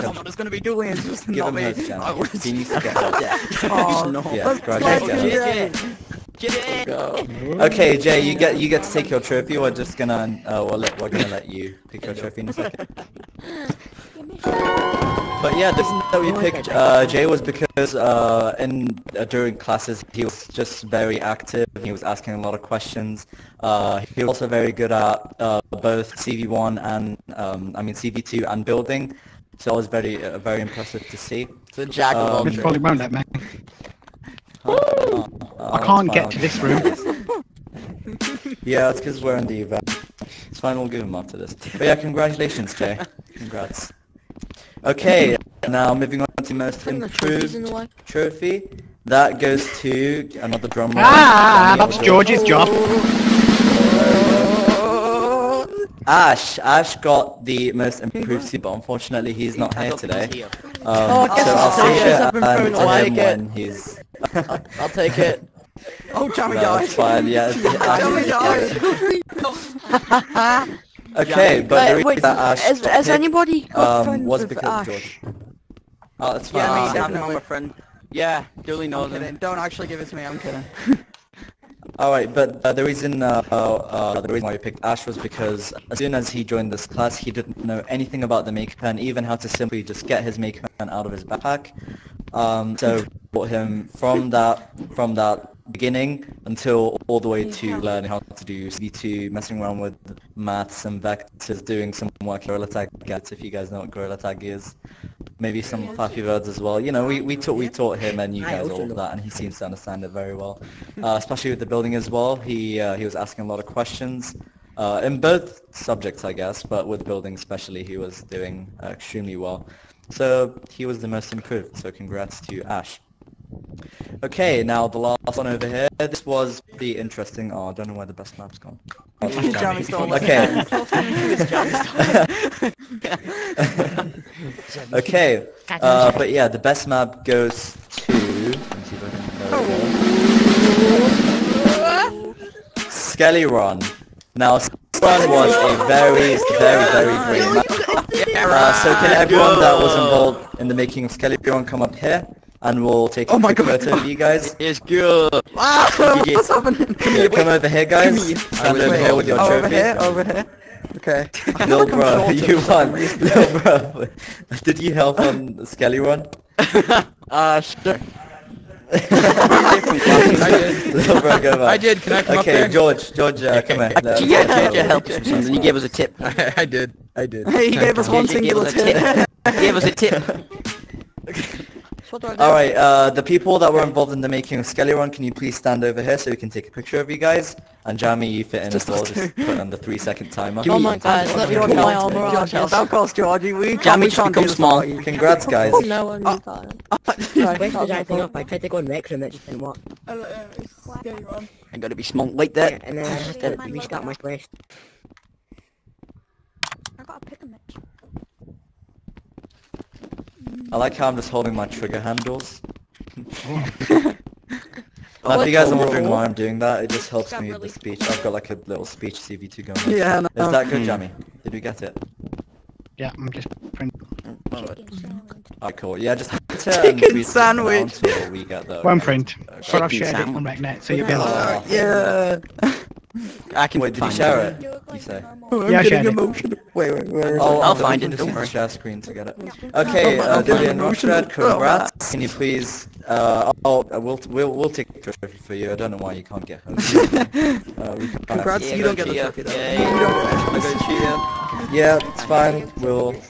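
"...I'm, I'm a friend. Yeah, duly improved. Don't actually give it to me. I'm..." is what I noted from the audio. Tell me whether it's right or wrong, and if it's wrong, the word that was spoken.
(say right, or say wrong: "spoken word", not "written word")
wrong: "noted", not "improved".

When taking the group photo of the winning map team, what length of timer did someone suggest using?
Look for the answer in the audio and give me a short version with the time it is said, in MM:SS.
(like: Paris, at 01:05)
3 seconds, at 03:09.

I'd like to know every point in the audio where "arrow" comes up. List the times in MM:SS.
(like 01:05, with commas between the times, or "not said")
not said.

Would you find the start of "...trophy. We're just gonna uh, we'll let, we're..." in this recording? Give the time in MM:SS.
00:09.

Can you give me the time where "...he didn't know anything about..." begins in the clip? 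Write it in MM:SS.
01:27.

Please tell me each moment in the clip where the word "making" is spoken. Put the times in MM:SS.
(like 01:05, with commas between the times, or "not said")
02:30, 03:04.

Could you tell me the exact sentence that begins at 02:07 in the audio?
Oh, I don't know where the best map's gone.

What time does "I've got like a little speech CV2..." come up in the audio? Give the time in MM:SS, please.
03:38.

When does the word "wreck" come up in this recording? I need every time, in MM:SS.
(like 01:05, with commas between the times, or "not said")
03:18.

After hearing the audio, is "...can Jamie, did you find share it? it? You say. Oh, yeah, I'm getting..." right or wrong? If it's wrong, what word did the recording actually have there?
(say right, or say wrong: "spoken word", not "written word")
wrong: "Wait", not "Jamie".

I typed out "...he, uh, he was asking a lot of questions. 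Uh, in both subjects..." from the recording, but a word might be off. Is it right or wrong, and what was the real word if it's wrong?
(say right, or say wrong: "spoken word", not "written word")
right.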